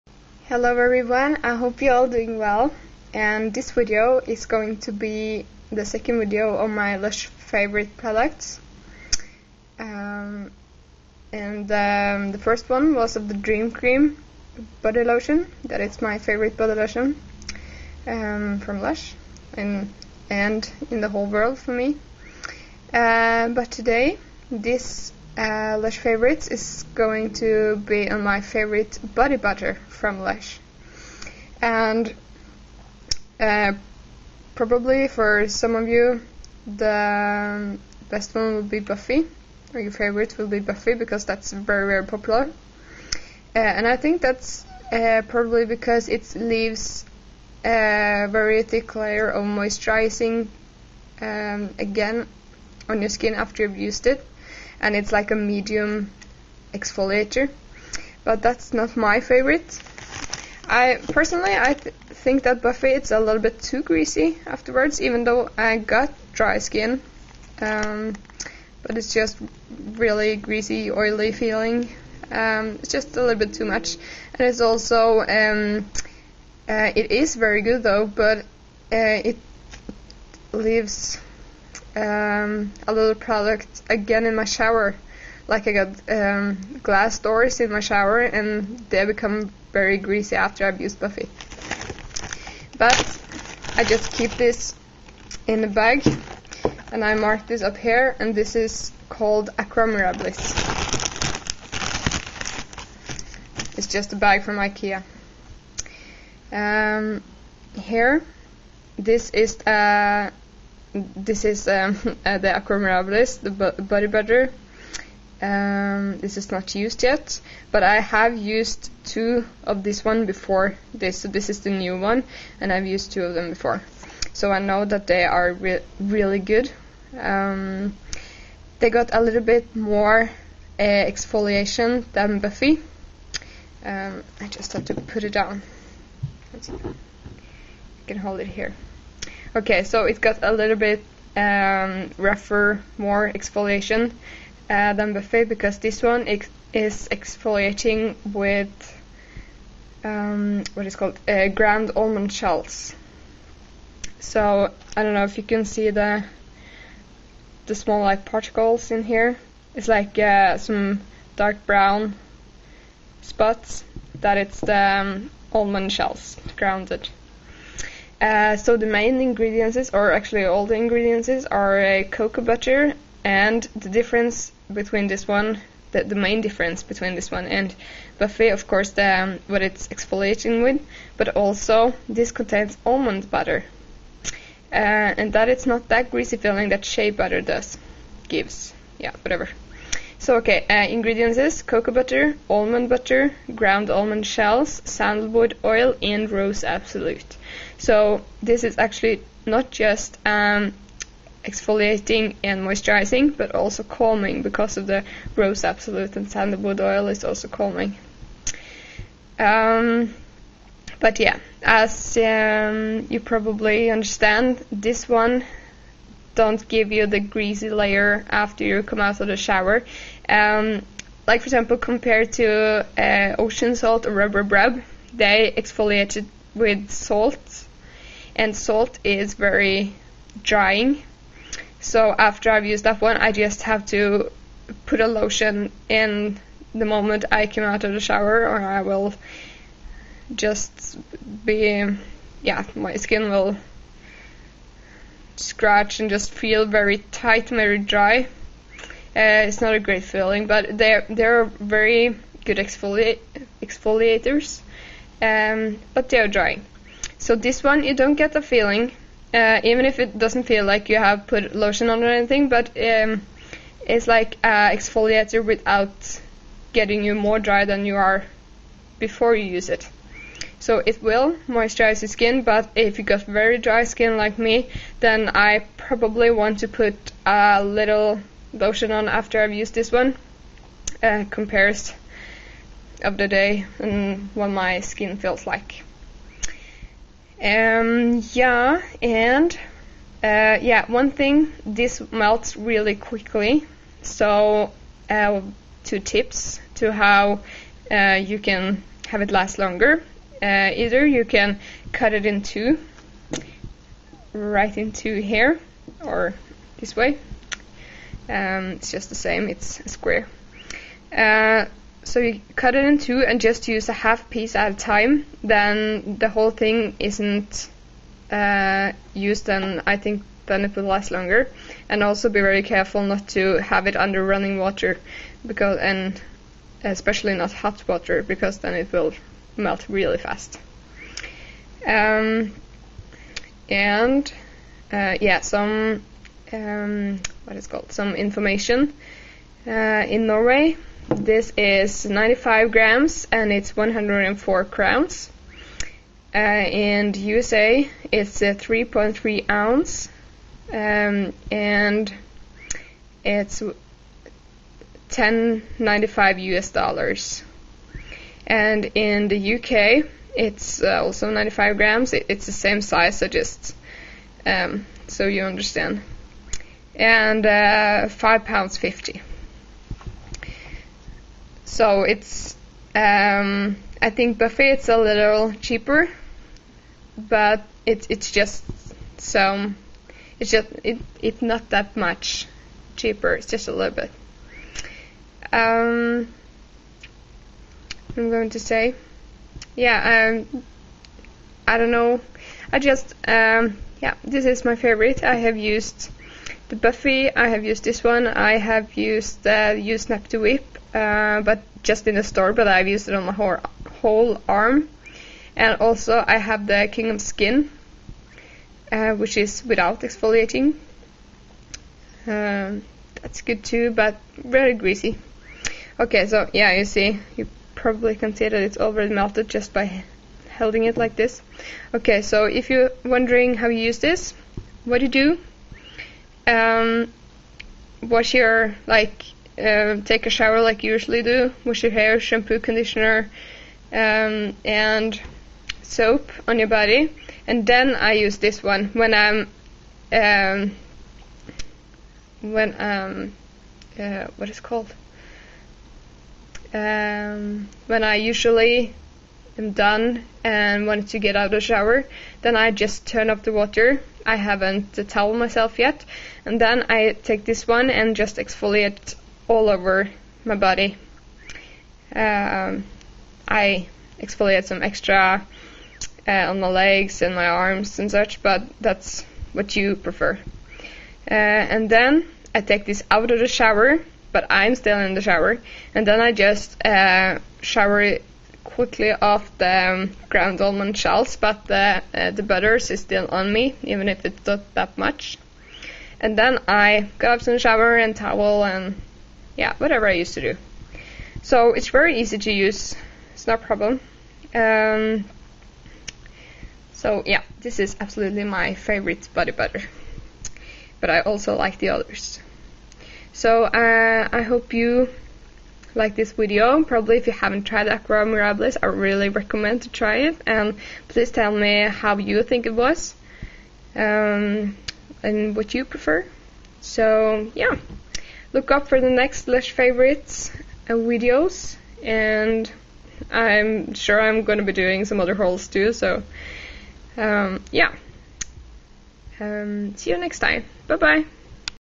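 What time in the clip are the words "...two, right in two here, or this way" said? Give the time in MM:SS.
05:02.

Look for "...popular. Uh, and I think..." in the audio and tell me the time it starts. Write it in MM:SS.
00:42.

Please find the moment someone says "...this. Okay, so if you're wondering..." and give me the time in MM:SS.
07:01.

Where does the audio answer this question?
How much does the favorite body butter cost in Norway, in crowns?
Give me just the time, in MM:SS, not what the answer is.
05:43.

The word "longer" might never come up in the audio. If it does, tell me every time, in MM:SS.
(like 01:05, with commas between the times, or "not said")
04:59, 05:21.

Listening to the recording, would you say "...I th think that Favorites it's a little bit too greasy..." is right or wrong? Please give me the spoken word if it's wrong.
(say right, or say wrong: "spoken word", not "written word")
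wrong: "Buffy", not "Favorites".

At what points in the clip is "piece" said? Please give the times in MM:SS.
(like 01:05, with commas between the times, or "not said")
05:14.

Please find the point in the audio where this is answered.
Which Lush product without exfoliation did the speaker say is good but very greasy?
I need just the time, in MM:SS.
06:46.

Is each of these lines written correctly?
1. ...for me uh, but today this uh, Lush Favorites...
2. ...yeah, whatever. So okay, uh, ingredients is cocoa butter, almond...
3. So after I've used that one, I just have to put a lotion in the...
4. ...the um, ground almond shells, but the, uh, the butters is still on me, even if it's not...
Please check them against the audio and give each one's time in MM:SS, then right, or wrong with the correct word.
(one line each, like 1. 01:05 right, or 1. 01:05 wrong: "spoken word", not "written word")
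1. 00:21 right
2. 03:08 right
3. 03:51 right
4. 07:59 right.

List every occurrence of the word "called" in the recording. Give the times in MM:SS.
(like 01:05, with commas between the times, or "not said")
01:39, 02:30, 05:37, 07:24.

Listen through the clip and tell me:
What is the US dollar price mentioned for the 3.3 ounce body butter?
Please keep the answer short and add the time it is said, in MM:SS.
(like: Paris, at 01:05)
$10.95, at 05:55.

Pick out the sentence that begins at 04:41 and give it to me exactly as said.
Uh, compares of the day and what my skin feels like.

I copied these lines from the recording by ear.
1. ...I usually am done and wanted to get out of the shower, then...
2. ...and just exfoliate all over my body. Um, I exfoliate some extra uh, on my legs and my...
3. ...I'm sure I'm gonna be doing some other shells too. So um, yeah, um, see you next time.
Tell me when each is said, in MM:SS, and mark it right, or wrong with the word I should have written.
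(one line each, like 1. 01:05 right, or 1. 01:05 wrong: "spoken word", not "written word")
1. 07:28 right
2. 07:37 right
3. 08:43 wrong: "hauls", not "shells".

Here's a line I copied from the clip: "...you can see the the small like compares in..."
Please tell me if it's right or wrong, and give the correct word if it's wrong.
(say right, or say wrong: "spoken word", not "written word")
wrong: "particles", not "compares".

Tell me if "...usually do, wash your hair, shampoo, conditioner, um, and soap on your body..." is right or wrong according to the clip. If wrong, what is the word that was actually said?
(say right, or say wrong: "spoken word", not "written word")
right.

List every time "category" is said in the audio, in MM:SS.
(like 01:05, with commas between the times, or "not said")
not said.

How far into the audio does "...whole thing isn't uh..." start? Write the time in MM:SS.
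05:16.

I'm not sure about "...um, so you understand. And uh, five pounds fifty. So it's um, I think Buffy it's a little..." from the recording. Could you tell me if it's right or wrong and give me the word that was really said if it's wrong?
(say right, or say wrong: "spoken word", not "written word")
right.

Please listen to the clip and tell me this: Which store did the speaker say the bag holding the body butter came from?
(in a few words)
Ikea.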